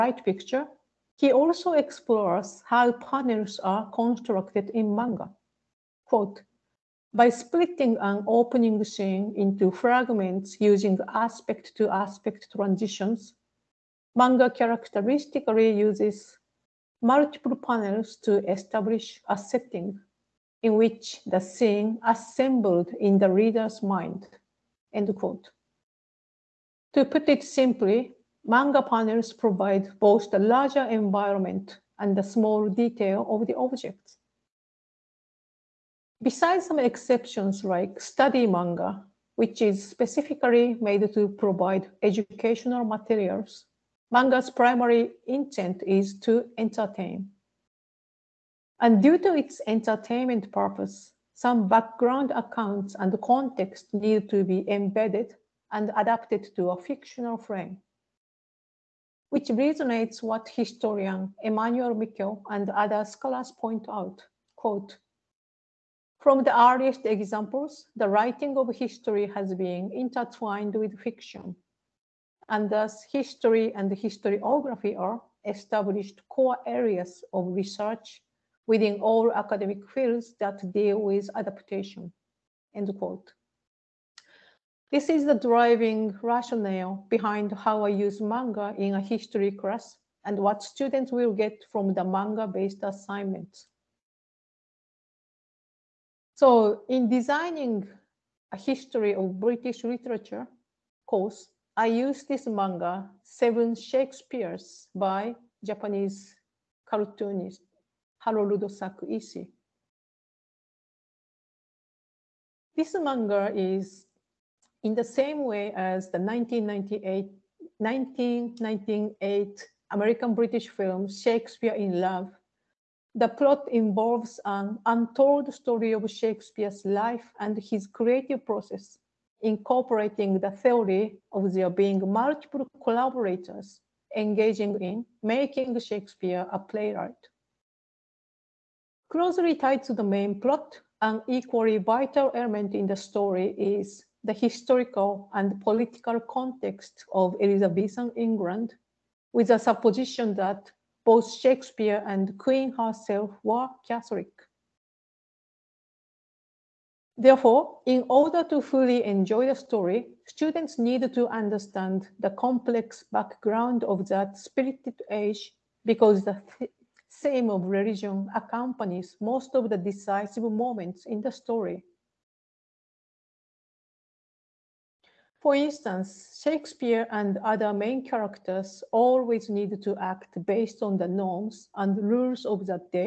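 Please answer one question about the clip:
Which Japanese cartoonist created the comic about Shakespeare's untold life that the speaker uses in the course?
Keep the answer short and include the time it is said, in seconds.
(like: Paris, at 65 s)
Harold Sakuishi, at 108 s.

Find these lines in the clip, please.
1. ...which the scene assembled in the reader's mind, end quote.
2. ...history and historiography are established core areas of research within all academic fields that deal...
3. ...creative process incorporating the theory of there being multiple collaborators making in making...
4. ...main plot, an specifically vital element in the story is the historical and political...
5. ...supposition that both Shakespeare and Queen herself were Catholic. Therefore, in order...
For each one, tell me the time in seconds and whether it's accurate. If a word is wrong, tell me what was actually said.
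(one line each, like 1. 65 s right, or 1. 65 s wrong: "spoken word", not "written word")
1. 20 s right
2. 73 s right
3. 127 s wrong: "engaging", not "making"
4. 140 s wrong: "equally", not "specifically"
5. 149 s right.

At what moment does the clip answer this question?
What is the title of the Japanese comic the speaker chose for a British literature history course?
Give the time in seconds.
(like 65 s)
103 s.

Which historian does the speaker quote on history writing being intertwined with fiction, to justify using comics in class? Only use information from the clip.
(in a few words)
Emmanuel Mikkel.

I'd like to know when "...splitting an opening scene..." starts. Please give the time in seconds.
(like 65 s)
7 s.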